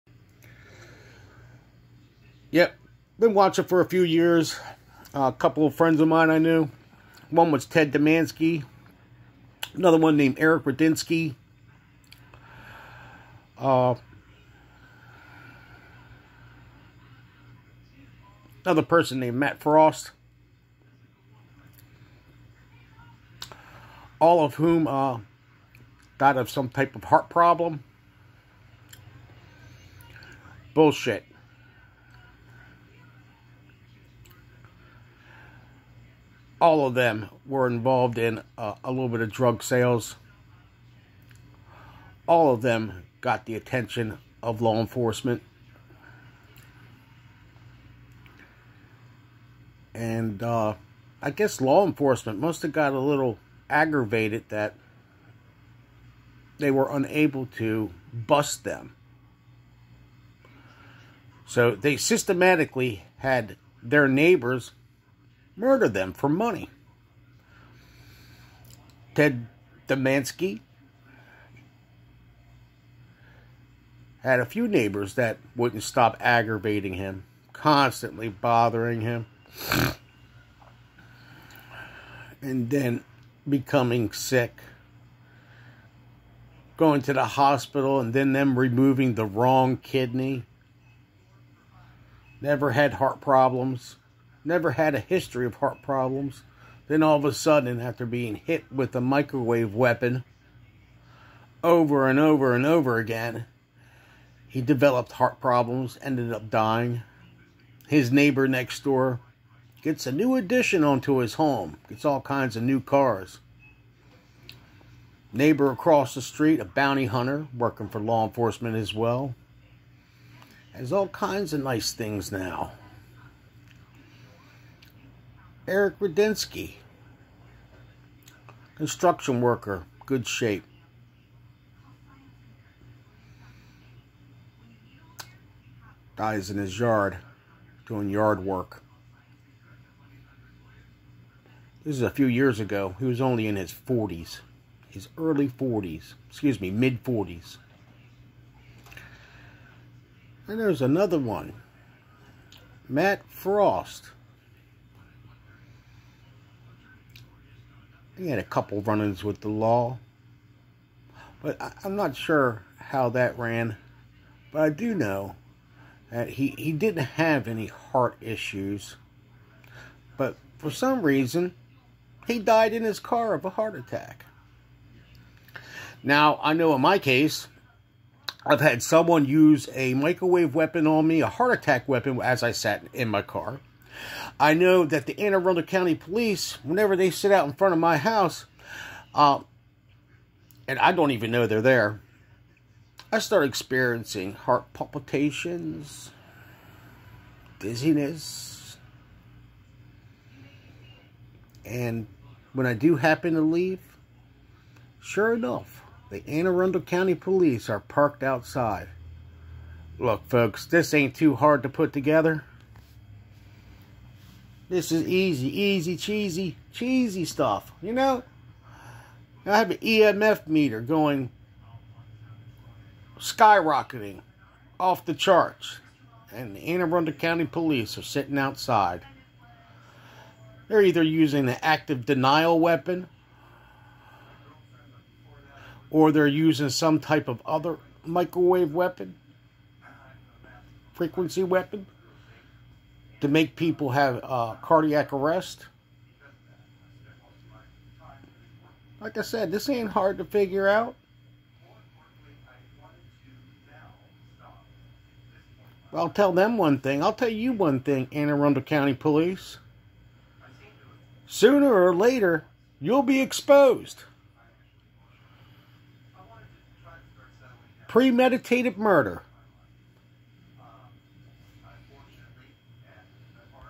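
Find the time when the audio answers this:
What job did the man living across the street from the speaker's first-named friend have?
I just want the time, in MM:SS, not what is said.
01:56.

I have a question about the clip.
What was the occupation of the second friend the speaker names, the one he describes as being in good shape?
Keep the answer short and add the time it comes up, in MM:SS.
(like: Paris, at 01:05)
construction worker, at 02:08.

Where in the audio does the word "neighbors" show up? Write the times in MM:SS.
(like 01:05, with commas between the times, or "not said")
01:04, 01:14, 01:48, 01:55.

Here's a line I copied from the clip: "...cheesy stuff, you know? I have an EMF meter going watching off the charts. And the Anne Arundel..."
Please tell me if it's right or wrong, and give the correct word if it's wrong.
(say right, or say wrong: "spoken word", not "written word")
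wrong: "skyrocketing", not "watching".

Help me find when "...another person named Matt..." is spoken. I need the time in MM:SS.
00:18.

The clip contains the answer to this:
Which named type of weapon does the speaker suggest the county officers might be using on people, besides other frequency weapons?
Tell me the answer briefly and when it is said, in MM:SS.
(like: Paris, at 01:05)
active denial weapon, at 03:51.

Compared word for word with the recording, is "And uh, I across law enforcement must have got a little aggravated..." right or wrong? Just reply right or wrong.
wrong.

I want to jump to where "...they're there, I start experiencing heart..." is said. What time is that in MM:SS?
03:11.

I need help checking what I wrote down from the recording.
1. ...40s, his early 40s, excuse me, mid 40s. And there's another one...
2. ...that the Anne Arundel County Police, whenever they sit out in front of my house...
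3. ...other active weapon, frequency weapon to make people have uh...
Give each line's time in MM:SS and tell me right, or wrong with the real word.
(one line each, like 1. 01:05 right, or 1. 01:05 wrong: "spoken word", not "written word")
1. 02:23 right
2. 03:04 right
3. 03:57 wrong: "microwave", not "active".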